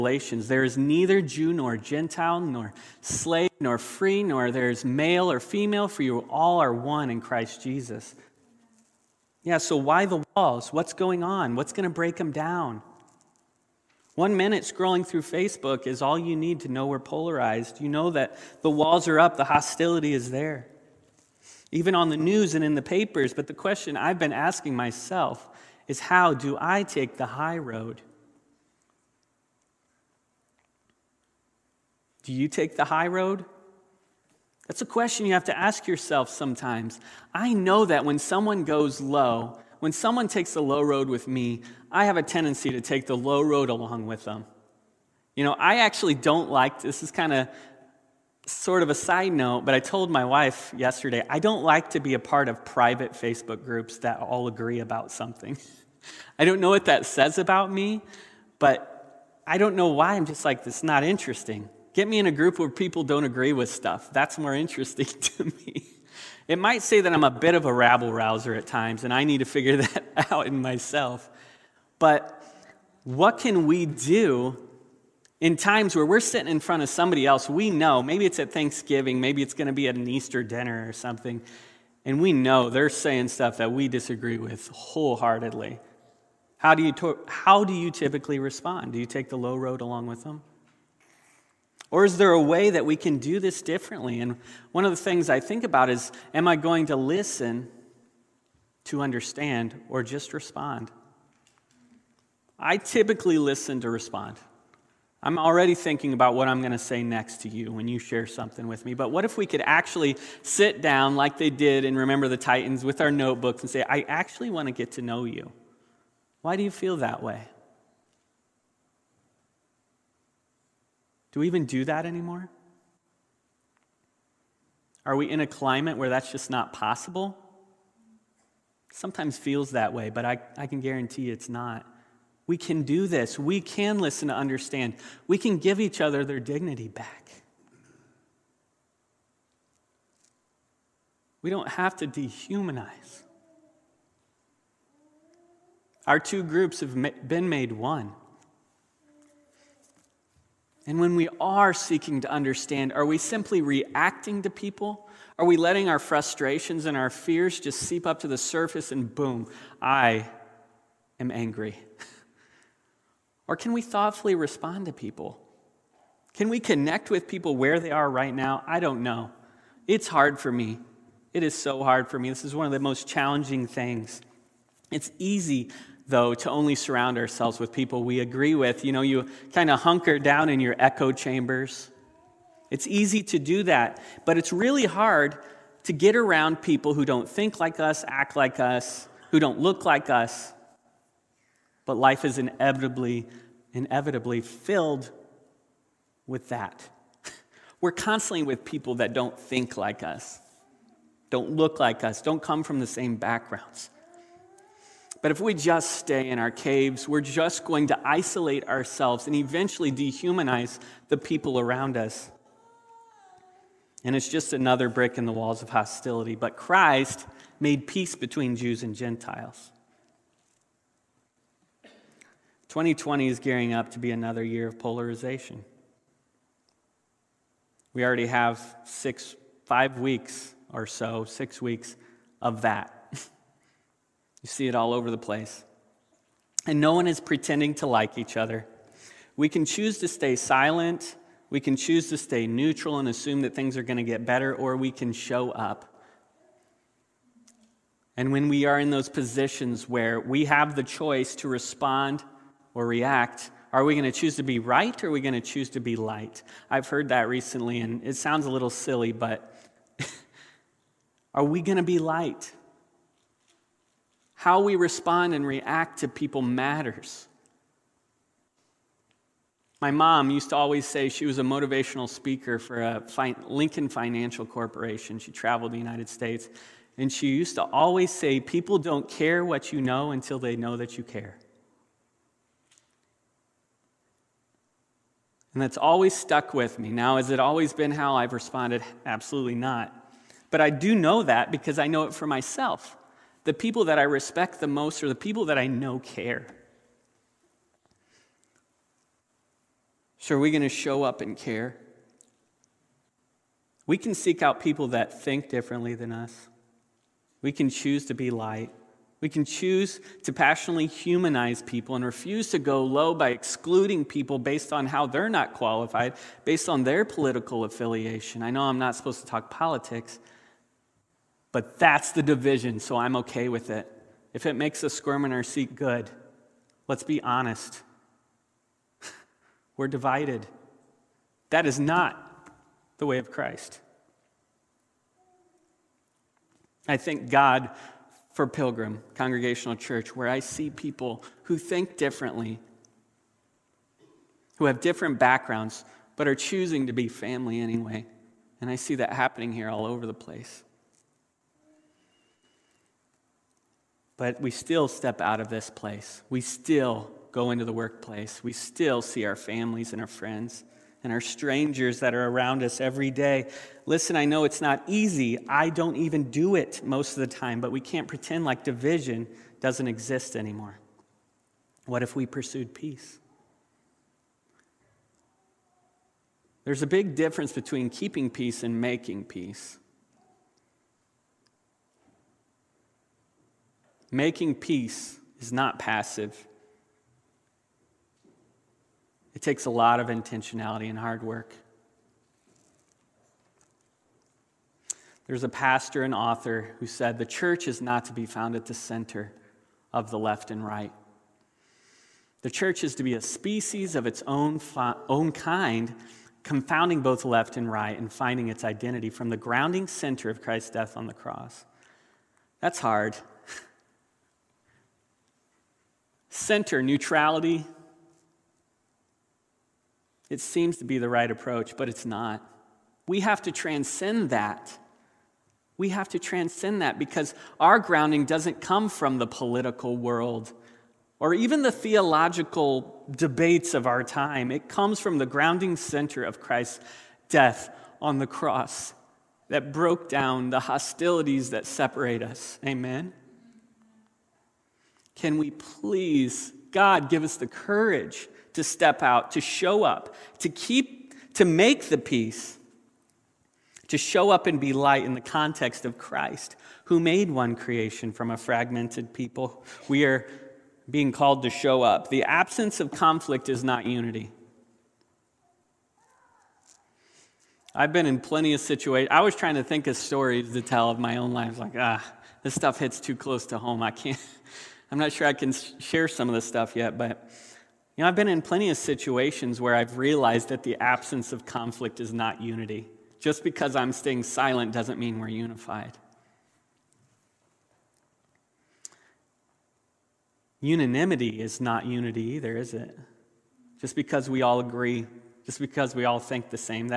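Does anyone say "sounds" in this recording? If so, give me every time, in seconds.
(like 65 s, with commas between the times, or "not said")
258 s.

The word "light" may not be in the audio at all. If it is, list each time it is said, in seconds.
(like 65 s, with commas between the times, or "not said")
255 s, 261 s, 308 s, 454 s.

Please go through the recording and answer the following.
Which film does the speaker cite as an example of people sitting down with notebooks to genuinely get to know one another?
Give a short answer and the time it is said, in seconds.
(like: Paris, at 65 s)
Remember the Titans, at 111 s.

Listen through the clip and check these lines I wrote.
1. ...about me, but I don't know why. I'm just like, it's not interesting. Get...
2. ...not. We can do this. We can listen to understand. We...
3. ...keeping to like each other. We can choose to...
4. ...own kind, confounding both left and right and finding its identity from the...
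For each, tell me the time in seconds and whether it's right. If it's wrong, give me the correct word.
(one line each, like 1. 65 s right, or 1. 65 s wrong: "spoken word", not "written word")
1. 57 s right
2. 131 s right
3. 237 s wrong: "pretending", not "keeping"
4. 405 s right.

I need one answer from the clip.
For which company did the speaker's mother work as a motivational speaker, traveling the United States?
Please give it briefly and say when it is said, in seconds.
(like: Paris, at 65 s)
Lincoln Financial Corporation, at 273 s.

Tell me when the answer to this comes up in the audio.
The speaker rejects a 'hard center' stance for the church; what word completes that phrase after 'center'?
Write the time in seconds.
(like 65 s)
416 s.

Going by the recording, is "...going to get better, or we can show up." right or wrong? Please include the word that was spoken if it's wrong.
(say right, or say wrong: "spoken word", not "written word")
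right.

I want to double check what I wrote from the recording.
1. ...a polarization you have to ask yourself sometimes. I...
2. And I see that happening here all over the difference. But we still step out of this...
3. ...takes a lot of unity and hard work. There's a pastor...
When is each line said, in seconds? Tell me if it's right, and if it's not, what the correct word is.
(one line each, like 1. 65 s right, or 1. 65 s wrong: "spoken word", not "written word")
1. 34 s wrong: "question", not "polarization"
2. 348 s wrong: "place", not "difference"
3. 389 s wrong: "intentionality", not "unity".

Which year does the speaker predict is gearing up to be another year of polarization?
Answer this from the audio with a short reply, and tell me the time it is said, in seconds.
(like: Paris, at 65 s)
2020, at 222 s.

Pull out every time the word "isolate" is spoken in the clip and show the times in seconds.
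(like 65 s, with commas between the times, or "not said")
208 s.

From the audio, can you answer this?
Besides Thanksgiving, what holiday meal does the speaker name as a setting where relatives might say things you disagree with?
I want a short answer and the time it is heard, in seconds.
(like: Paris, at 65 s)
Easter dinner, at 80 s.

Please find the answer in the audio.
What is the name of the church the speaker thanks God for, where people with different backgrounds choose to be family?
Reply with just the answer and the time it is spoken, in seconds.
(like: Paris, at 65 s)
Pilgrim Congregational Church, at 338 s.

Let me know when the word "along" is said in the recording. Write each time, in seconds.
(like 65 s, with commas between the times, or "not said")
43 s, 89 s.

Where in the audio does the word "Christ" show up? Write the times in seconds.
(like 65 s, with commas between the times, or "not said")
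7 s, 216 s, 333 s, 410 s, 436 s, 455 s.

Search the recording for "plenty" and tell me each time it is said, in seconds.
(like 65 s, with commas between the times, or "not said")
468 s, 478 s.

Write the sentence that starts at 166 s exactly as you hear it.
Can we connect with people where they are right now?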